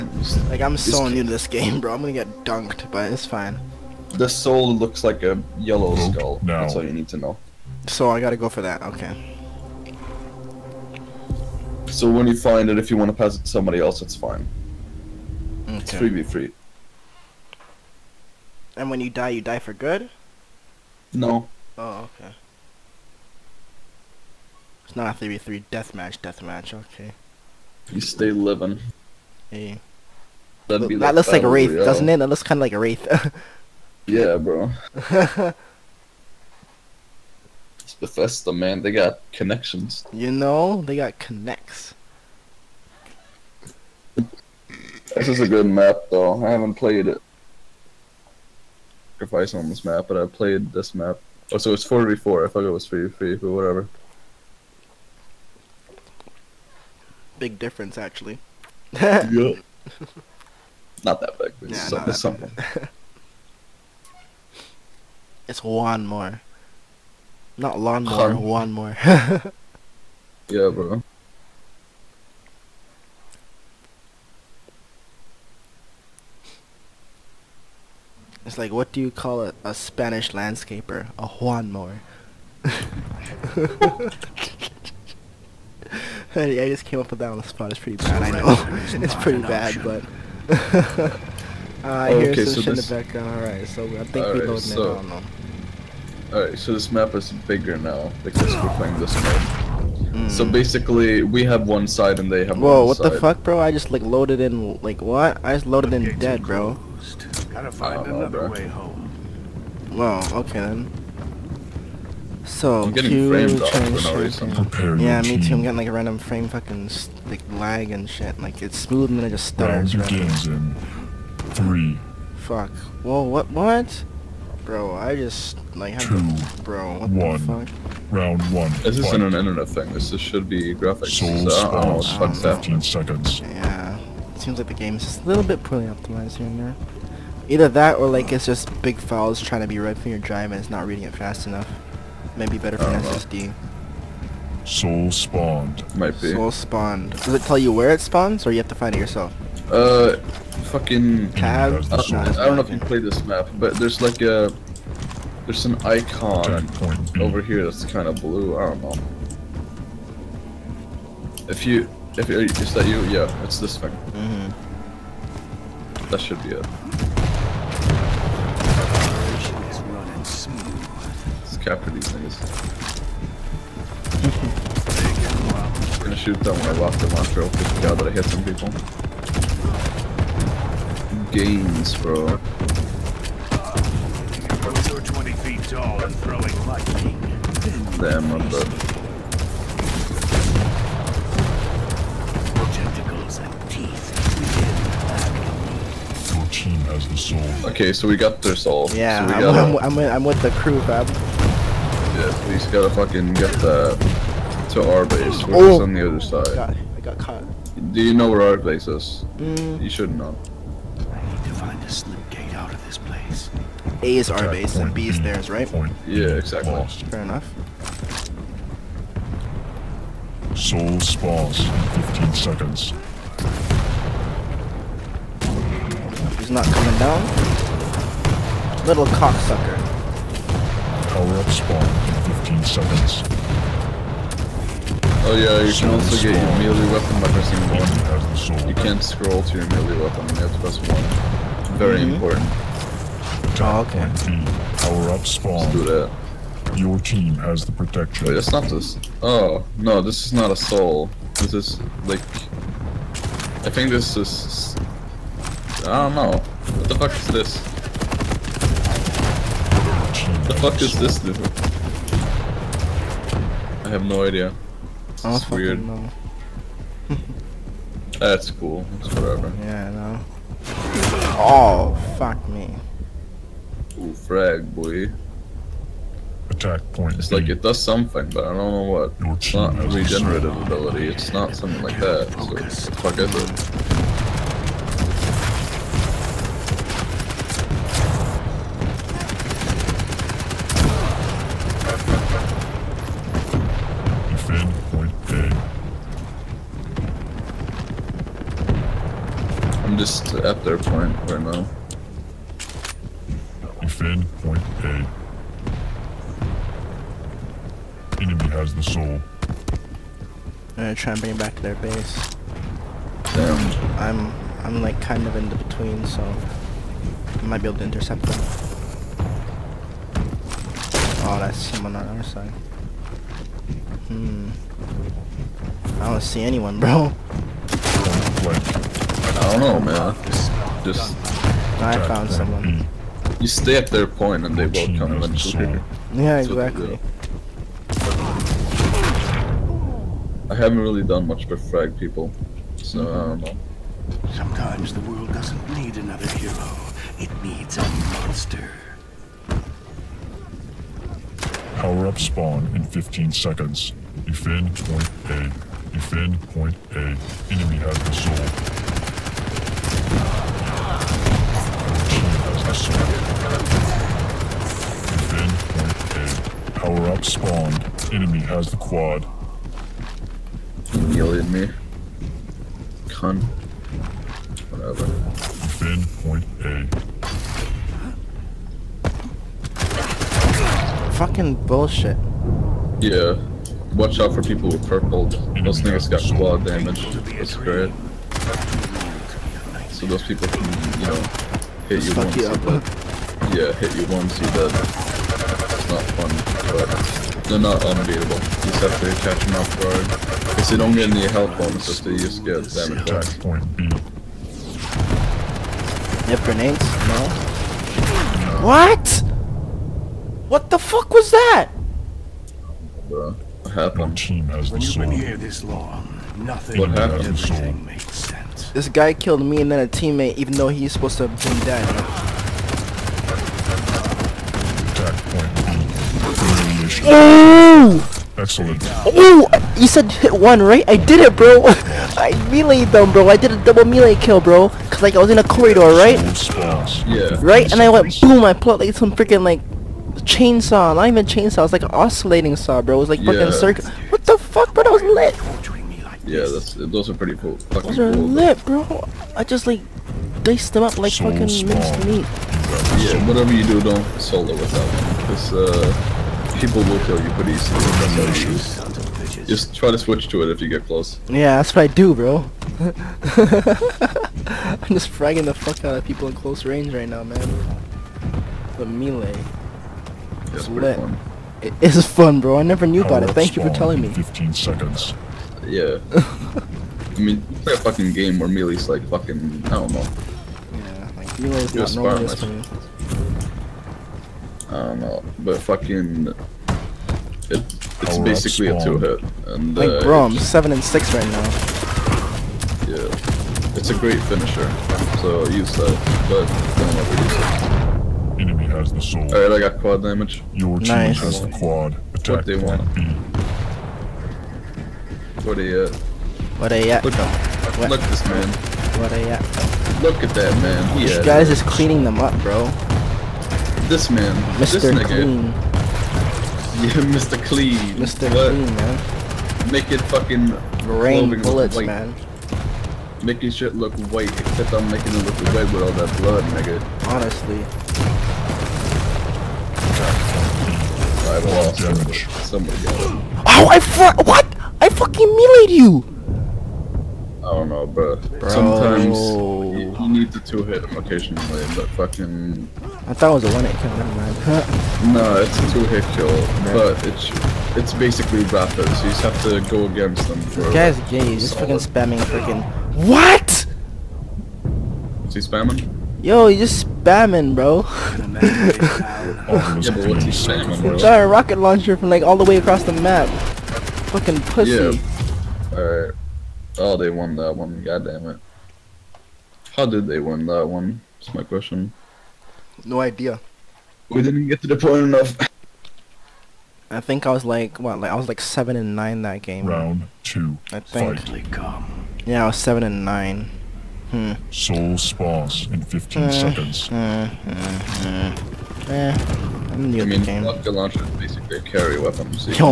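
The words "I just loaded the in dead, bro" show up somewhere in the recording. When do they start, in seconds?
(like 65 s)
105 s.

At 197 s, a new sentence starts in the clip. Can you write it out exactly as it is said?
Okay, so we got their soul.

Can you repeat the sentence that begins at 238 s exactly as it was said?
You can't scroll to your melee weapon, you have to press 1.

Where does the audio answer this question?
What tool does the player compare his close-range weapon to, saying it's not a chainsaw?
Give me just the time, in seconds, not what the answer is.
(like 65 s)
441 s.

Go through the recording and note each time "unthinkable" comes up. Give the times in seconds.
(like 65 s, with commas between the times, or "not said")
not said.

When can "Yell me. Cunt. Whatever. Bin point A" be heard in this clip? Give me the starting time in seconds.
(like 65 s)
371 s.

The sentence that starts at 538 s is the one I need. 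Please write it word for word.
Sometimes you, need the two hit occasionally, but fucking.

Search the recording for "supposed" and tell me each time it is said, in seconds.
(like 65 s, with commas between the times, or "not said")
420 s.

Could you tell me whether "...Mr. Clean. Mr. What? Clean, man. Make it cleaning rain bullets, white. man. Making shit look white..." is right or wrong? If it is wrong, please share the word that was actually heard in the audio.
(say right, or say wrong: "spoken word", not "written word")
wrong: "fucking", not "cleaning".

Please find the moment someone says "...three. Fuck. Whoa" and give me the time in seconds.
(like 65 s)
121 s.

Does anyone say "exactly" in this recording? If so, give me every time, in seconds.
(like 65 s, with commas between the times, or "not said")
216 s, 336 s.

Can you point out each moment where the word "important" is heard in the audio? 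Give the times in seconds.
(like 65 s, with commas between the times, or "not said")
242 s.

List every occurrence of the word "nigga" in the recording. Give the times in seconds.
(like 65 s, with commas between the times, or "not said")
385 s, 514 s, 526 s.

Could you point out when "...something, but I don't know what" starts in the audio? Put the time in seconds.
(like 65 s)
277 s.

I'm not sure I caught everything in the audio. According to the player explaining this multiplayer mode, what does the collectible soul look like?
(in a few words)
A yellow skull.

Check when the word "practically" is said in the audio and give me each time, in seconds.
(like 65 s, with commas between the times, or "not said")
not said.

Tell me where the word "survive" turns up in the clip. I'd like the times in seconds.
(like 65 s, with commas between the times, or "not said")
not said.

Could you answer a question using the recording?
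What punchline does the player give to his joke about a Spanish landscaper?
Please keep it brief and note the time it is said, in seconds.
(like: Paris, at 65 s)
A Juan mower, at 81 s.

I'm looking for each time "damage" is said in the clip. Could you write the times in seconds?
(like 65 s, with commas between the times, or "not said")
386 s, 402 s, 500 s.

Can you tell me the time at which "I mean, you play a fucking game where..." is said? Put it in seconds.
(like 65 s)
476 s.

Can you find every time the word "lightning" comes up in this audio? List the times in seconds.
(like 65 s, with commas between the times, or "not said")
186 s.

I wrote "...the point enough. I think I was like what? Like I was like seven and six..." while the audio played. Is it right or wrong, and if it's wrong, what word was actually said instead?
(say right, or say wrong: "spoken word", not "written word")
wrong: "nine", not "six".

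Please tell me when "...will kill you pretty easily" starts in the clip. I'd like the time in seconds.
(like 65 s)
456 s.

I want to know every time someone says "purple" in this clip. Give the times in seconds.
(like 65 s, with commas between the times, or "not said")
384 s.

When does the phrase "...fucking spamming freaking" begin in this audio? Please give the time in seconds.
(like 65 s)
551 s.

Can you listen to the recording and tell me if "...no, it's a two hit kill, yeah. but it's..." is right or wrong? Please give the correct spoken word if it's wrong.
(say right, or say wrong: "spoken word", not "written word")
right.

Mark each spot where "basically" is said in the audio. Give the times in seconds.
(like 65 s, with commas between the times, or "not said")
100 s, 488 s, 547 s, 591 s.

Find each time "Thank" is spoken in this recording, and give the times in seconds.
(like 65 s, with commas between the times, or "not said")
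473 s.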